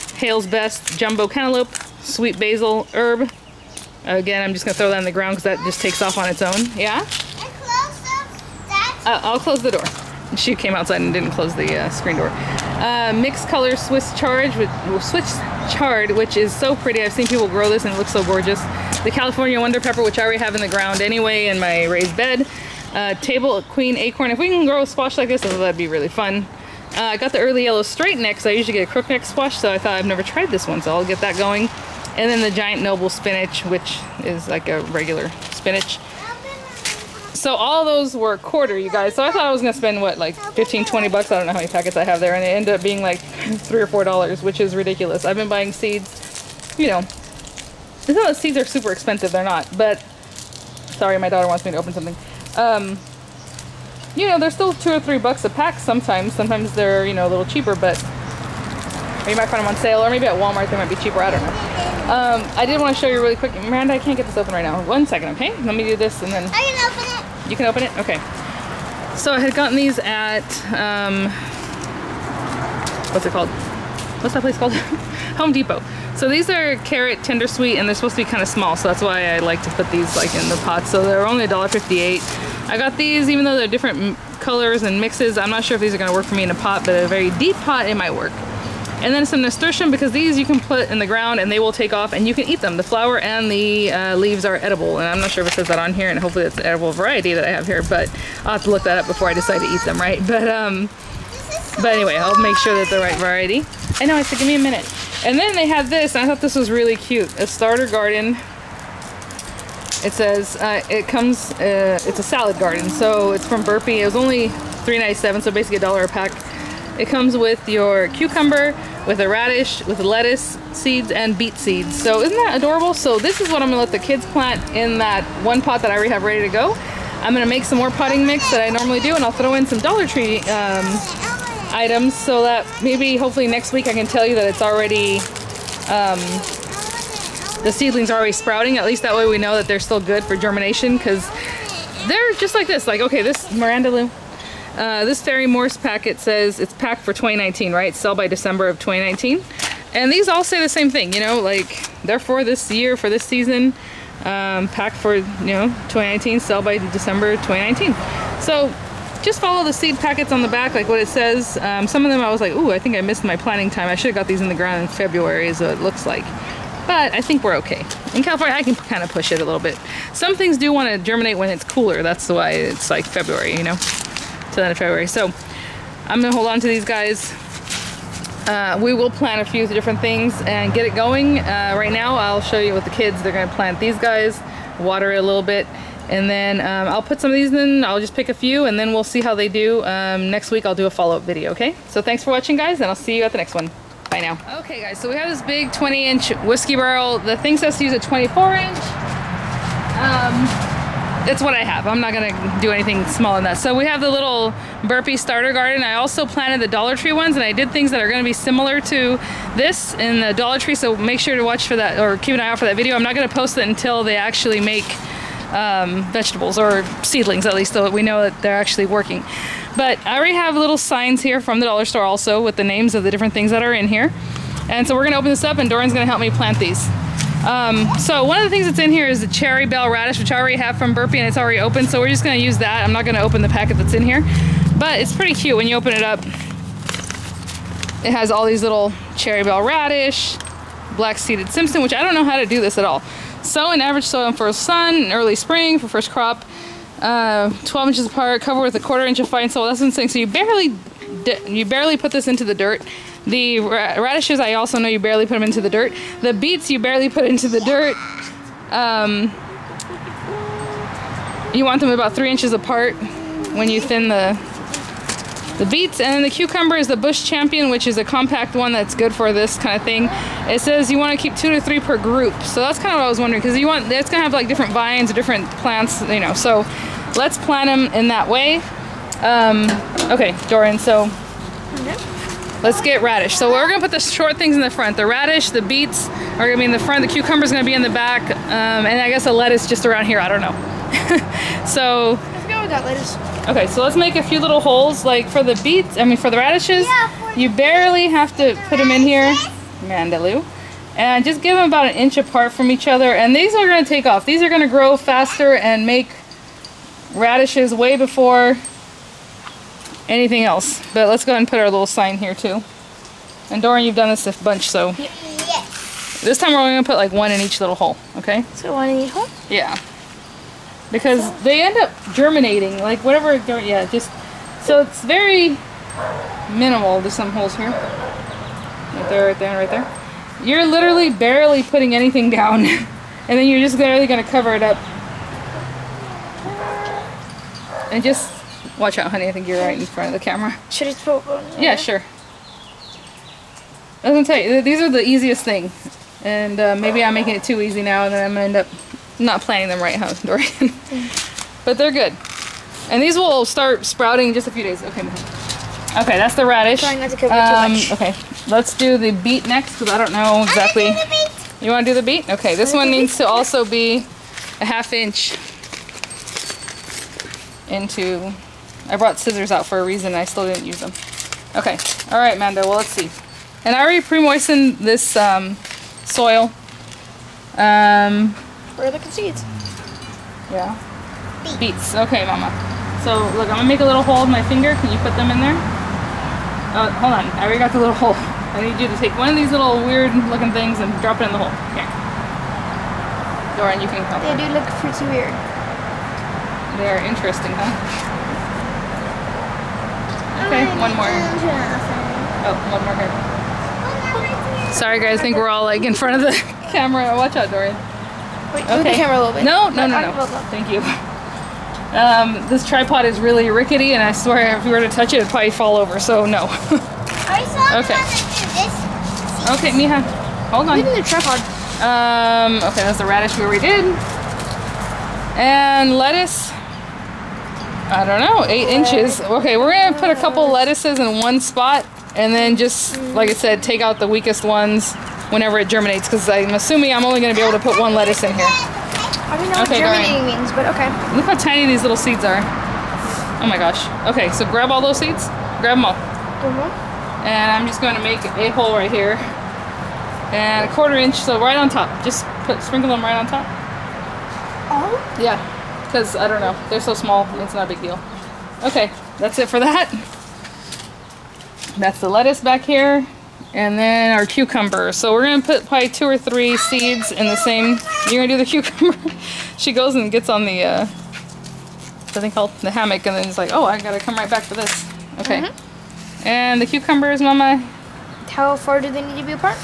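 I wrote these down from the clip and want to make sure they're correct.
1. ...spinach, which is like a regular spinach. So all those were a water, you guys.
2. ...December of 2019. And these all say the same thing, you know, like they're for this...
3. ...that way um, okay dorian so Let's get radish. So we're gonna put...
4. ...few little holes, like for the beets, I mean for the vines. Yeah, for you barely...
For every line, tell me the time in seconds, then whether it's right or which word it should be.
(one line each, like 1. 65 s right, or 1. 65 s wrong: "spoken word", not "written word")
1. 33 s wrong: "quarter", not "water"
2. 148 s right
3. 278 s right
4. 294 s wrong: "radishes", not "vines".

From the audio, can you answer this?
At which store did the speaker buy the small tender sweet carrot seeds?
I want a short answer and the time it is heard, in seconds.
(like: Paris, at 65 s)
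Home Depot, at 75 s.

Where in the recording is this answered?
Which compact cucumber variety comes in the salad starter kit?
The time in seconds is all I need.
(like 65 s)
266 s.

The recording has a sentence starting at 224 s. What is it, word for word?
And so we're gonna open this up and Dorian's gonna help me plant these.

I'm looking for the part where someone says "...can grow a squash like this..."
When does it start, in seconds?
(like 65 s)
24 s.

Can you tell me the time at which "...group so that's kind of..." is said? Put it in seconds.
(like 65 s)
271 s.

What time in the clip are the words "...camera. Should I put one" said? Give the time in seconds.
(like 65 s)
340 s.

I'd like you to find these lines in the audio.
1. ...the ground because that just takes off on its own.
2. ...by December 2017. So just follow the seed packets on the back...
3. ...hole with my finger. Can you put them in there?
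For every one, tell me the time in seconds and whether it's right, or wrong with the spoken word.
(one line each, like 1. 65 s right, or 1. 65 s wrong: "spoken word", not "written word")
1. 5 s right
2. 156 s wrong: "2019", not "2017"
3. 384 s right.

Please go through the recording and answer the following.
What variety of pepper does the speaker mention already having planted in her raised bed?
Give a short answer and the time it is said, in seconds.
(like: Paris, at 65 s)
California Wonder, at 19 s.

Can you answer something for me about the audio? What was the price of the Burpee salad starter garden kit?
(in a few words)
$3.97.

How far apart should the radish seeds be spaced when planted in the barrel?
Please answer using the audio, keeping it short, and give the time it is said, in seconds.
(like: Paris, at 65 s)
an inch, at 301 s.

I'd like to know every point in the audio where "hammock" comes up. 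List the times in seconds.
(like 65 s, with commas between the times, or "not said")
472 s.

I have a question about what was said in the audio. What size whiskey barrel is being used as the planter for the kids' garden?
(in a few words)
20 inch.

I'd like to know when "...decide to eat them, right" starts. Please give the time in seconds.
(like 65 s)
99 s.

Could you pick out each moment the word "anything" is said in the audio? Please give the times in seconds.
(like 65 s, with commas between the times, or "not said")
202 s, 310 s, 331 s.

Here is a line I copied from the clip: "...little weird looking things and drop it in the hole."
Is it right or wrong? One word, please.
right.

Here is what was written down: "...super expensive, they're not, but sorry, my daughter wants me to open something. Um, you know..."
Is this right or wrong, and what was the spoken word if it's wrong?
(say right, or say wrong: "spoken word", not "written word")
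right.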